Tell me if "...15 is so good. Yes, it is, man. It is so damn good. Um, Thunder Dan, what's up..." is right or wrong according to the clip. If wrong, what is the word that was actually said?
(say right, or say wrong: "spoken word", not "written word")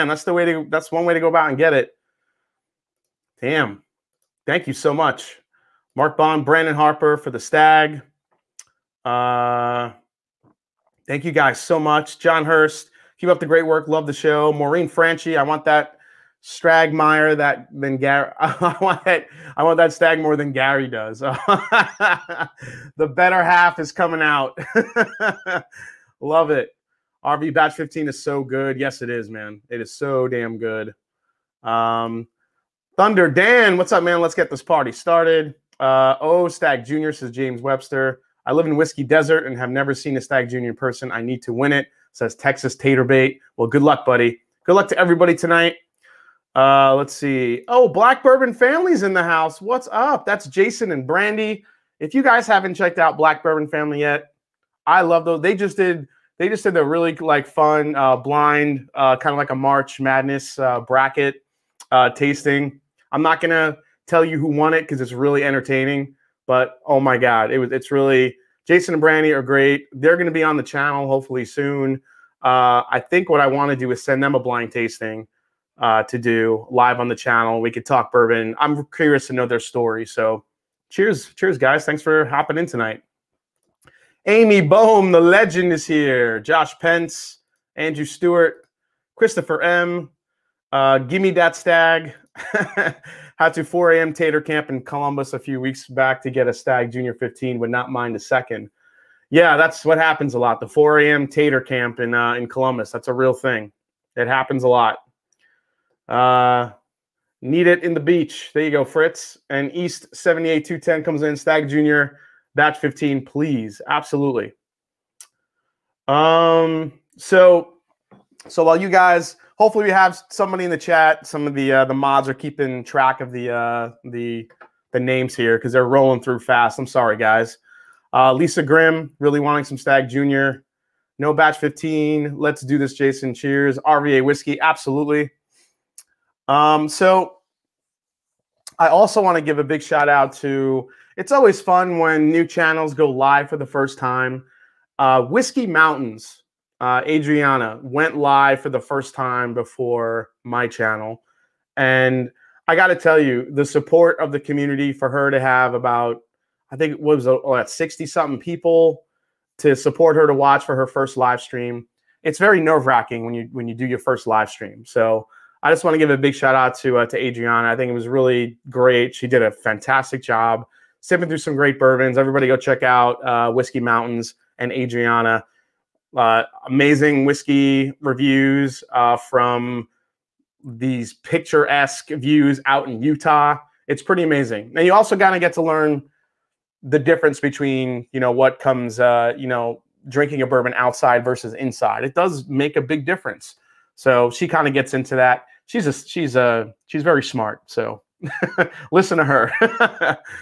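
right.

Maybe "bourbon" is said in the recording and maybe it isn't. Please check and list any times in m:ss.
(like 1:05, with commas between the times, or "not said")
0:48, 0:53, 1:18, 2:51, 3:10.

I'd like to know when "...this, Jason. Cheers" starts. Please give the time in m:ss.
2:12.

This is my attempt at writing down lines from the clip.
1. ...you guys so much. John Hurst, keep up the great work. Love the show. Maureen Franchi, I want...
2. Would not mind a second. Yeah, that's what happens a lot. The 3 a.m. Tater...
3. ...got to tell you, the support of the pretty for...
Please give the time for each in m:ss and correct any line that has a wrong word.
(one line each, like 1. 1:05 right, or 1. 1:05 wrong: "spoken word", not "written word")
1. 0:11 right
2. 1:37 wrong: "4", not "3"
3. 2:32 wrong: "community", not "pretty".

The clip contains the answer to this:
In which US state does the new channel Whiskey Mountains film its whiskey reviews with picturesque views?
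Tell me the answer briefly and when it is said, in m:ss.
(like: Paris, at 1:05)
Utah, at 3:03.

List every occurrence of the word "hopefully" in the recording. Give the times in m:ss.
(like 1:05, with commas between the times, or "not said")
1:11, 1:59.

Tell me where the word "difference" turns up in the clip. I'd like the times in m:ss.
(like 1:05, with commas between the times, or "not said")
3:07, 3:13.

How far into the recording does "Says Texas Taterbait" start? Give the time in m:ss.
0:42.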